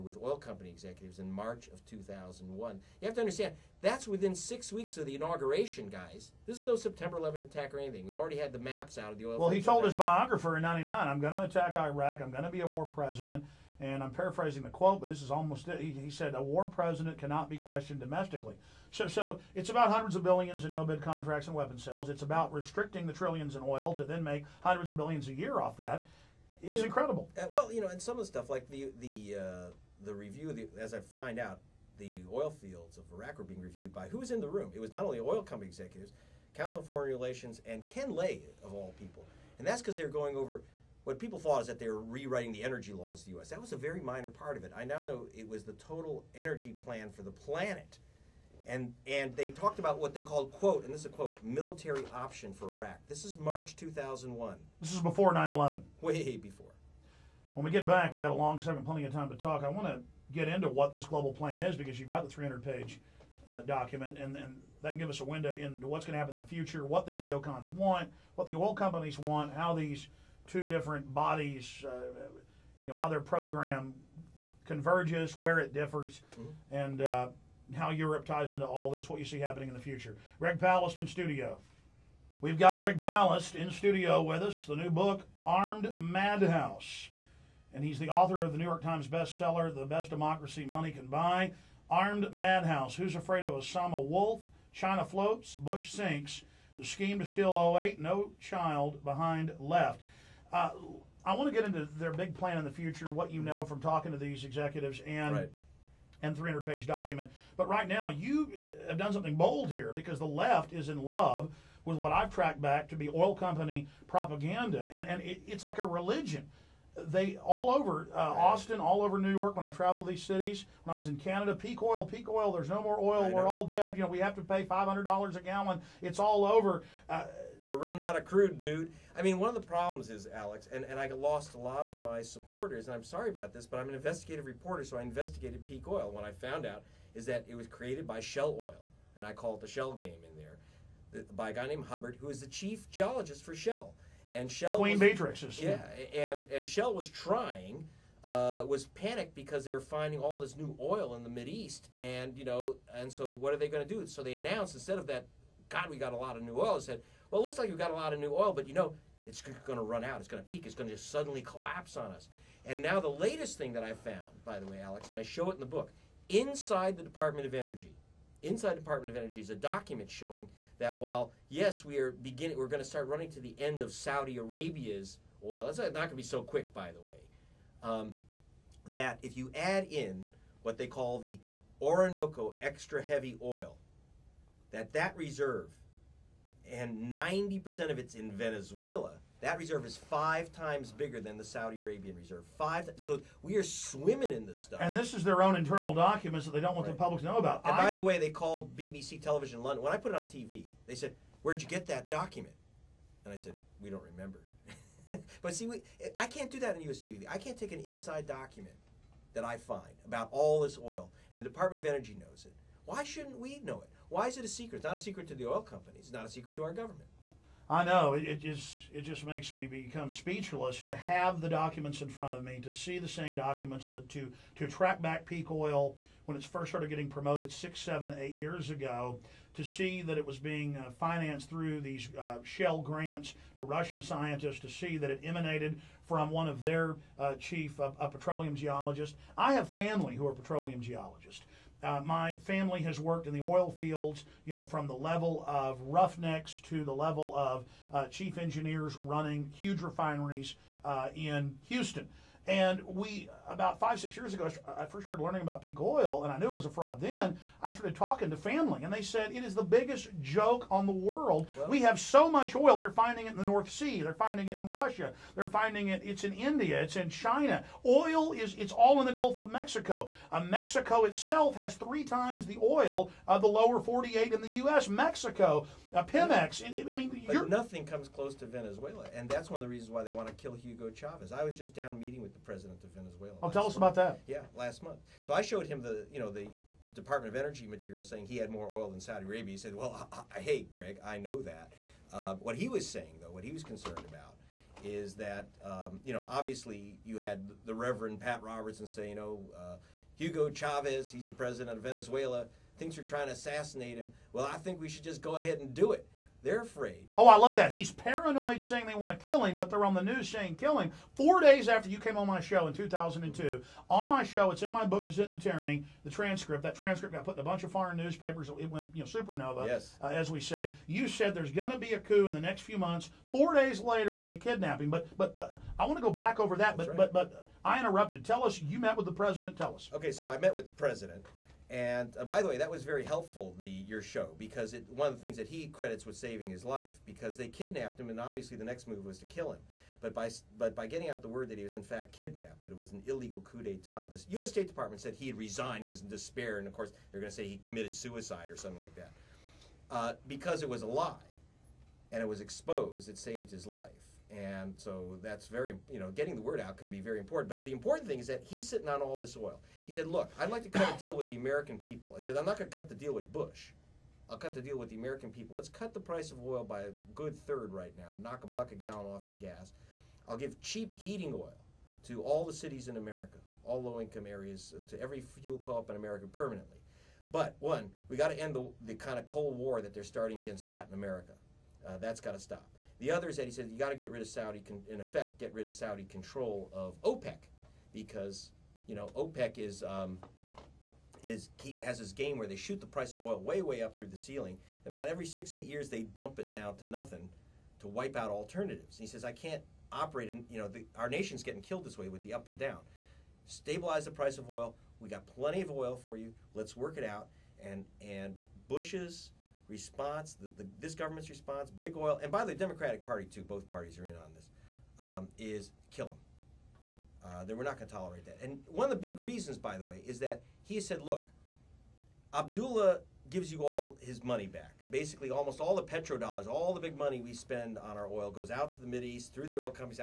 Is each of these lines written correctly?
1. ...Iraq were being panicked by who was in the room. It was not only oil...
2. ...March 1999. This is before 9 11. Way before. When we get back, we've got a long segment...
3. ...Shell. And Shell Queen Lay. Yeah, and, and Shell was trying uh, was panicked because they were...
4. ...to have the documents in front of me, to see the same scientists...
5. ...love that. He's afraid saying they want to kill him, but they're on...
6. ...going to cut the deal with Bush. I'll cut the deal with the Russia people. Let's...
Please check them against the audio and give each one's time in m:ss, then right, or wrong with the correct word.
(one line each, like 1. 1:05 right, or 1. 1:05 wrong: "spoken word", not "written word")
1. 0:33 wrong: "reviewed", not "panicked"
2. 0:53 wrong: "2001", not "1999"
3. 2:23 wrong: "Matrixes", not "Lay"
4. 3:40 wrong: "documents", not "scientists"
5. 5:07 wrong: "paranoid", not "afraid"
6. 6:02 wrong: "American", not "Russia".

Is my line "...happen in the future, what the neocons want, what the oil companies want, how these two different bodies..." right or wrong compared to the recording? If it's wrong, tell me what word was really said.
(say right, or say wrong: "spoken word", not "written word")
right.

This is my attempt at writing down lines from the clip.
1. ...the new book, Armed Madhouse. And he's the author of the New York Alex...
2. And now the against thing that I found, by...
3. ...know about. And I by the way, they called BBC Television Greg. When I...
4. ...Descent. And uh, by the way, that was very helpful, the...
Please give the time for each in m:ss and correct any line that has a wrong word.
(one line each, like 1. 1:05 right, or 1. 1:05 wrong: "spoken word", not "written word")
1. 1:24 wrong: "Times", not "Alex"
2. 2:42 wrong: "latest", not "against"
3. 3:17 wrong: "London", not "Greg"
4. 5:30 wrong: "president", not "Descent".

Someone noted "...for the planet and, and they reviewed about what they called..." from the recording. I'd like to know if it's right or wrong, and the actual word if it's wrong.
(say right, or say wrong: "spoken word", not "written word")
wrong: "talked", not "reviewed".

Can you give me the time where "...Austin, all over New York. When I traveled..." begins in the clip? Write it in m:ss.
1:58.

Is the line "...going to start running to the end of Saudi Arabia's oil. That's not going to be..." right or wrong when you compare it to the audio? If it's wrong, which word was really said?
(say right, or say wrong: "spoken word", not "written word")
right.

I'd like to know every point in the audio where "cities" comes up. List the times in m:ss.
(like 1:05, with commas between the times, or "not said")
2:00, 6:12.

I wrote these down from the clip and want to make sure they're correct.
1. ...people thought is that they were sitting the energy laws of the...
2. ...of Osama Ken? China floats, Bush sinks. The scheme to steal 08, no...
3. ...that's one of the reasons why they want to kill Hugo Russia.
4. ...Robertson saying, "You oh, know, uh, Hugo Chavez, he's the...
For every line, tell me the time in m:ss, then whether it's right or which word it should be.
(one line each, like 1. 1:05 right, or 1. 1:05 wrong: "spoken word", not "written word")
1. 0:41 wrong: "rewriting", not "sitting"
2. 1:33 wrong: "Wolf", not "Ken"
3. 4:39 wrong: "Chavez", not "Russia"
4. 4:58 right.